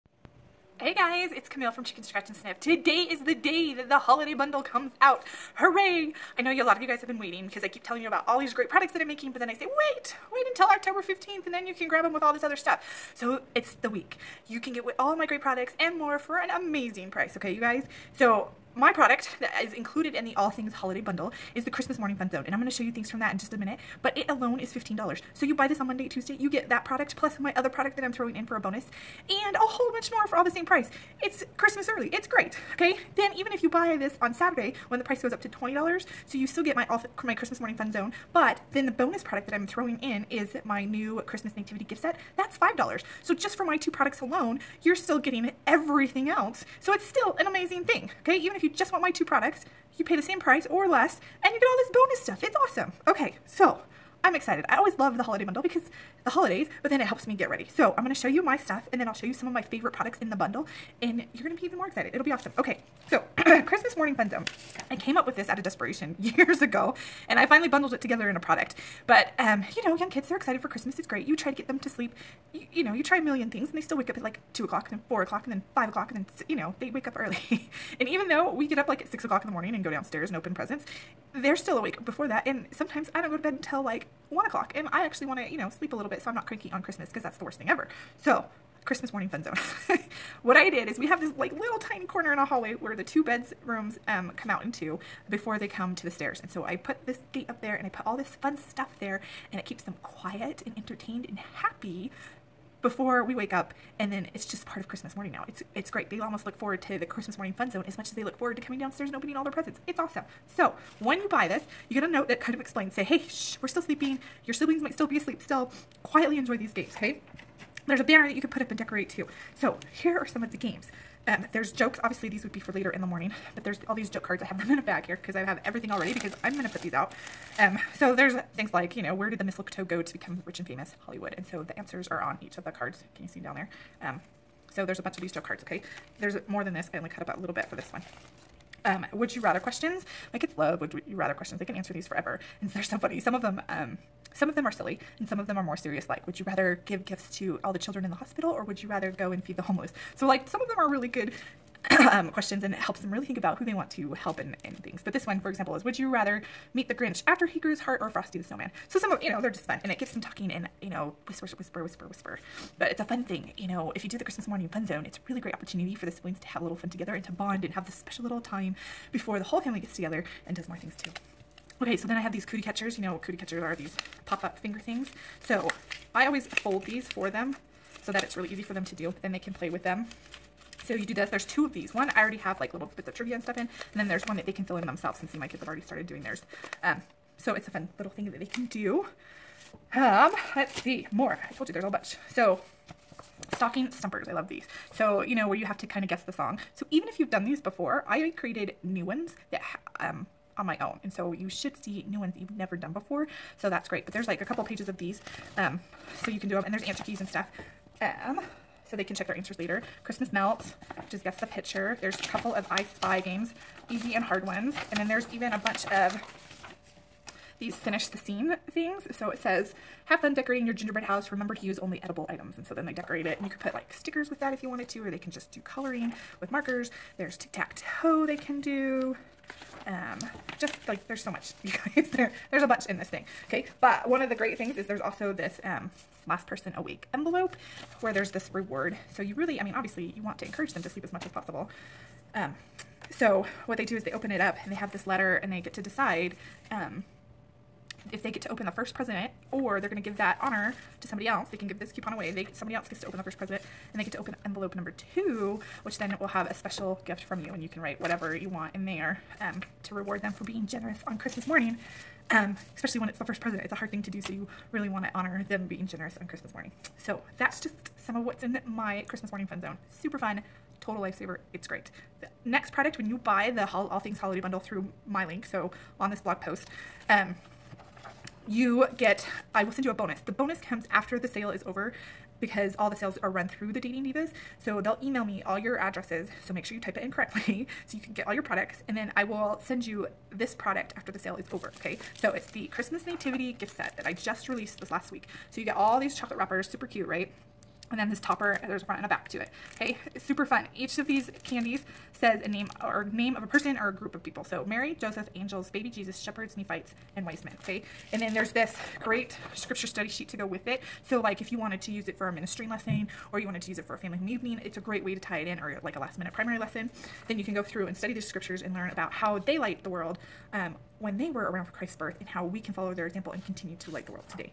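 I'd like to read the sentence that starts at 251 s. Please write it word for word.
They can give this coupon away.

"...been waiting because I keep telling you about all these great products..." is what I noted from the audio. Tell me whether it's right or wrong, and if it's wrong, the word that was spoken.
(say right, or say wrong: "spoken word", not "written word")
right.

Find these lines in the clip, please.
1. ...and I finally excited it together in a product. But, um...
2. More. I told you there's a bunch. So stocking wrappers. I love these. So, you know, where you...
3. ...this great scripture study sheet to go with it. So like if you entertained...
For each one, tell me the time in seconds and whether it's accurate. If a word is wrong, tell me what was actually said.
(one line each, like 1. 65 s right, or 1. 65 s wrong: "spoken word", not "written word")
1. 67 s wrong: "bundled", not "excited"
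2. 191 s wrong: "stumpers", not "wrappers"
3. 308 s wrong: "wanted", not "entertained".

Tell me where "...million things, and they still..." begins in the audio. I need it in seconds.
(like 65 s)
73 s.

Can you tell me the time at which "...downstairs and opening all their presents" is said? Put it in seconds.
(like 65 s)
108 s.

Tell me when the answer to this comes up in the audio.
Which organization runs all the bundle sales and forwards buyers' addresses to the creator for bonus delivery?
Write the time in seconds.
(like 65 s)
283 s.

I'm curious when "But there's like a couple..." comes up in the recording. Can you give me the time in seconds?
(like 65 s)
204 s.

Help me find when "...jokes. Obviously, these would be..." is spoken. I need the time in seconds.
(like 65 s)
121 s.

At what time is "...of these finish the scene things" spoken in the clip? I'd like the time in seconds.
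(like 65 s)
215 s.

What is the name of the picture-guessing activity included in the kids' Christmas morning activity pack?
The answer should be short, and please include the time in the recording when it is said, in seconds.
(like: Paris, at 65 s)
Christmas Melts, at 210 s.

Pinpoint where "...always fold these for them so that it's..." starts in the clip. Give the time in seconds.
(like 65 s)
176 s.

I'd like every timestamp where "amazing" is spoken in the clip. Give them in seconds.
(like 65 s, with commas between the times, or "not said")
16 s, 47 s.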